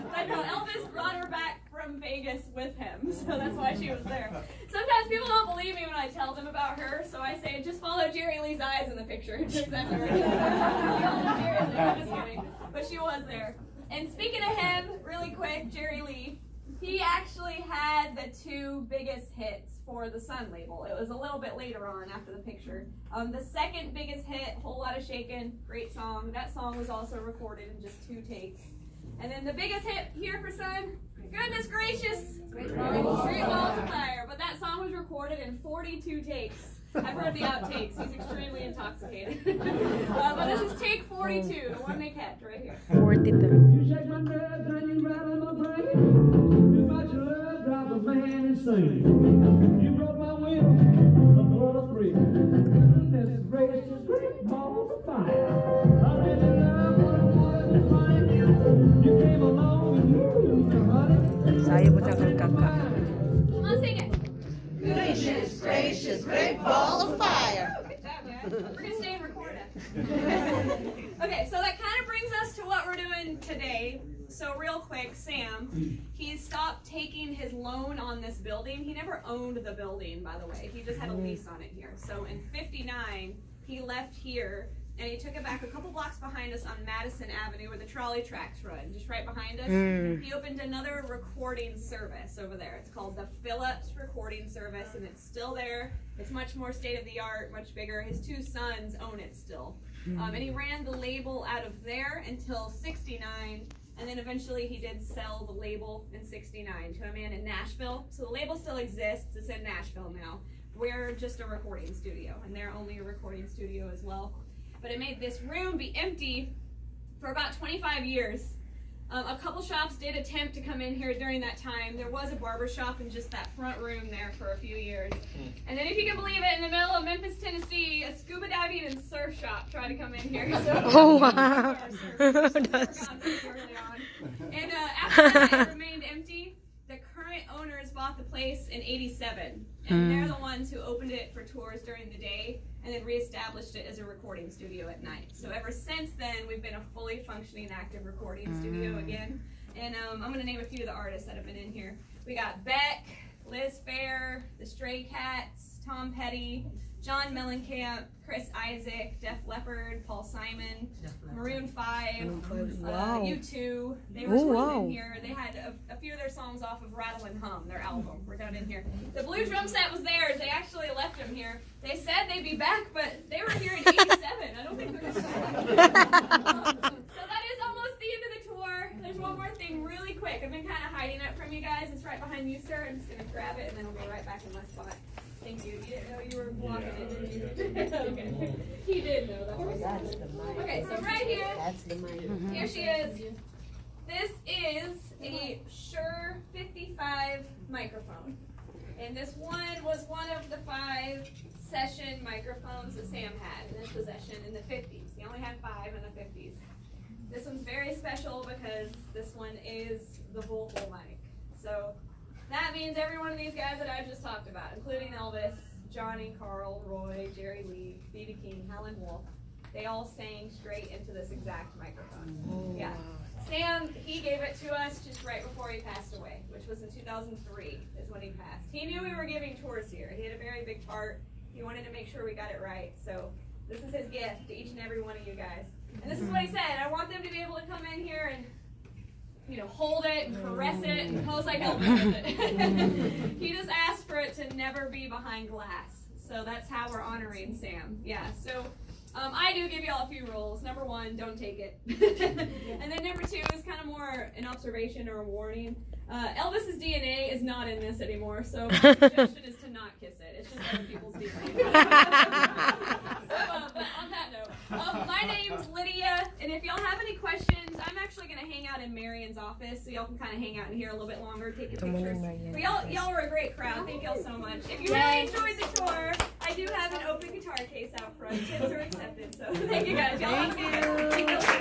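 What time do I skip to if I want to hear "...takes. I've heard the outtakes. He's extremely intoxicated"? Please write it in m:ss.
0:36.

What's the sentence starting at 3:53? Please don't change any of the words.
So this is his gift to each and every one of you guys.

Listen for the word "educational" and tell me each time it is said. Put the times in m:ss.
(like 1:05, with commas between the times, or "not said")
not said.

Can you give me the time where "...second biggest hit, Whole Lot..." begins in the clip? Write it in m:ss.
0:23.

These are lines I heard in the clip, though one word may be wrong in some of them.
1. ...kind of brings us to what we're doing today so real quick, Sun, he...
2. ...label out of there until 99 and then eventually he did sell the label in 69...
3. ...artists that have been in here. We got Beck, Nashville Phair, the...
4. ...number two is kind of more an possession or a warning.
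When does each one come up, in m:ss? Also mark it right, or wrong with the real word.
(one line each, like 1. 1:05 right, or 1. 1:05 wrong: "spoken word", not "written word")
1. 1:11 wrong: "Sam", not "Sun"
2. 1:40 wrong: "69", not "99"
3. 2:30 wrong: "Liz", not "Nashville"
4. 4:13 wrong: "observation", not "possession".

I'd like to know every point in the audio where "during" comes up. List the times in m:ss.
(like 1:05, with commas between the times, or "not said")
2:01, 2:21.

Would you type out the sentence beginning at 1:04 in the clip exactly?
Gracious, gracious, great ball of fire.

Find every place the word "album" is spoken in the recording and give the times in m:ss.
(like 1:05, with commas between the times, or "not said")
2:47.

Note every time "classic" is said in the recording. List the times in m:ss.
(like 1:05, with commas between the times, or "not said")
not said.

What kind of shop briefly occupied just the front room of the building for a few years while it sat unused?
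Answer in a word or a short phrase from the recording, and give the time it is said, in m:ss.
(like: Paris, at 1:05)
Barber shop, at 2:02.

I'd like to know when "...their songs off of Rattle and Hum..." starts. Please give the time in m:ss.
2:46.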